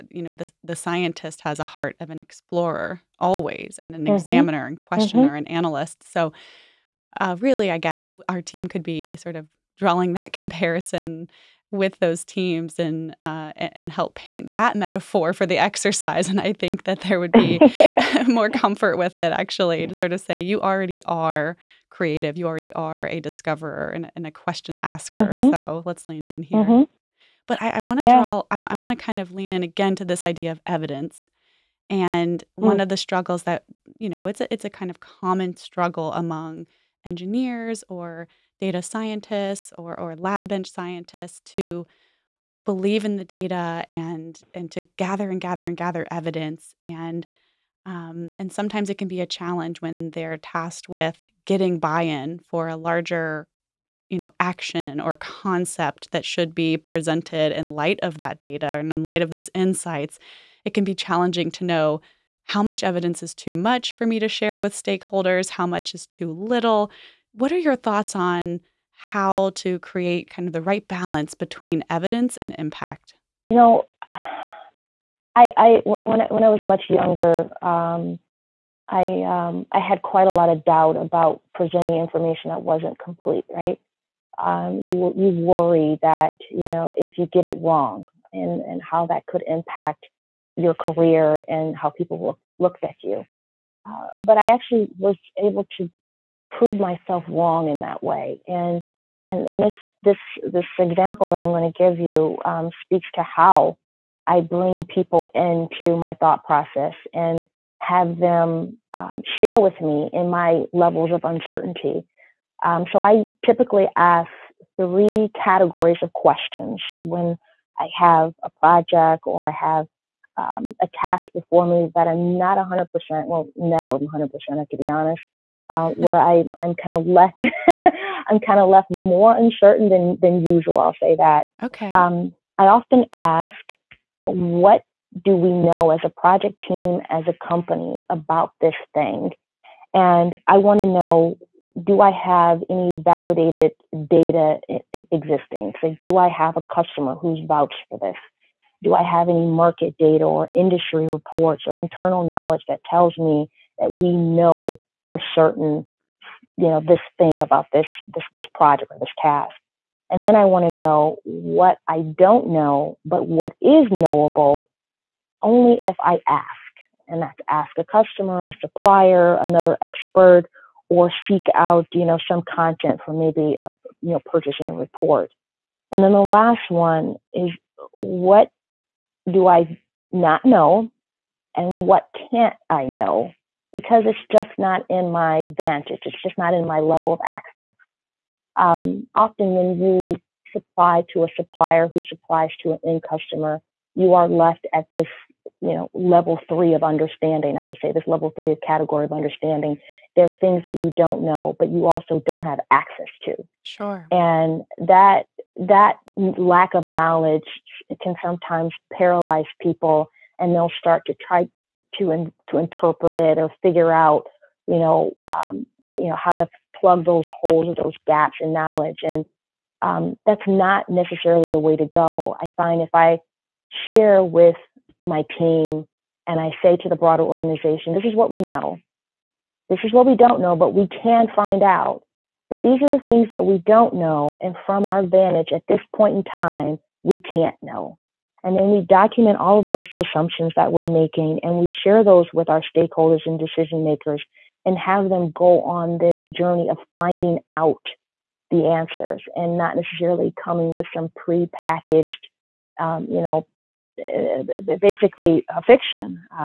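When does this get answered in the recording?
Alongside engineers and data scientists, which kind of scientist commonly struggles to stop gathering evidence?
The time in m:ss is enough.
0:40.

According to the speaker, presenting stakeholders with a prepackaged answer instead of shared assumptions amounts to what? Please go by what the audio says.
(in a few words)
a fiction.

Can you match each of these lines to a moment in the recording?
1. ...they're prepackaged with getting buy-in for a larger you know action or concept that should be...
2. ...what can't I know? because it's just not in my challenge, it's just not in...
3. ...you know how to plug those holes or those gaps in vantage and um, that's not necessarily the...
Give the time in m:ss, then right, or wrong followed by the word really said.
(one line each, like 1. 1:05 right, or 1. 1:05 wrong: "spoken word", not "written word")
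1. 0:50 wrong: "tasked", not "prepackaged"
2. 3:01 wrong: "vantage", not "challenge"
3. 3:35 wrong: "knowledge", not "vantage".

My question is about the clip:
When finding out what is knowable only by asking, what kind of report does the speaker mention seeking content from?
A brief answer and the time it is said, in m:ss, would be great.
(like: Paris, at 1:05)
purchasing report, at 2:54.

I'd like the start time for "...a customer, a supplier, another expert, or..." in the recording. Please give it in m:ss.
2:47.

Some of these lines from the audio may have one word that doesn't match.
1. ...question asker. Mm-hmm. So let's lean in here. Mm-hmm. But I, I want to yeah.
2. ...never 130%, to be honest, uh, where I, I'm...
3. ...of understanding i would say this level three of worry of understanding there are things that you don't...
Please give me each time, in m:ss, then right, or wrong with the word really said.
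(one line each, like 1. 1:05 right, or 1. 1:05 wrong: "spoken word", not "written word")
1. 0:24 right
2. 2:03 wrong: "100", not "130"
3. 3:16 wrong: "category", not "worry".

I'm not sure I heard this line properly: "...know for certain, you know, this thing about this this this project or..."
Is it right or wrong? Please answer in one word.
right.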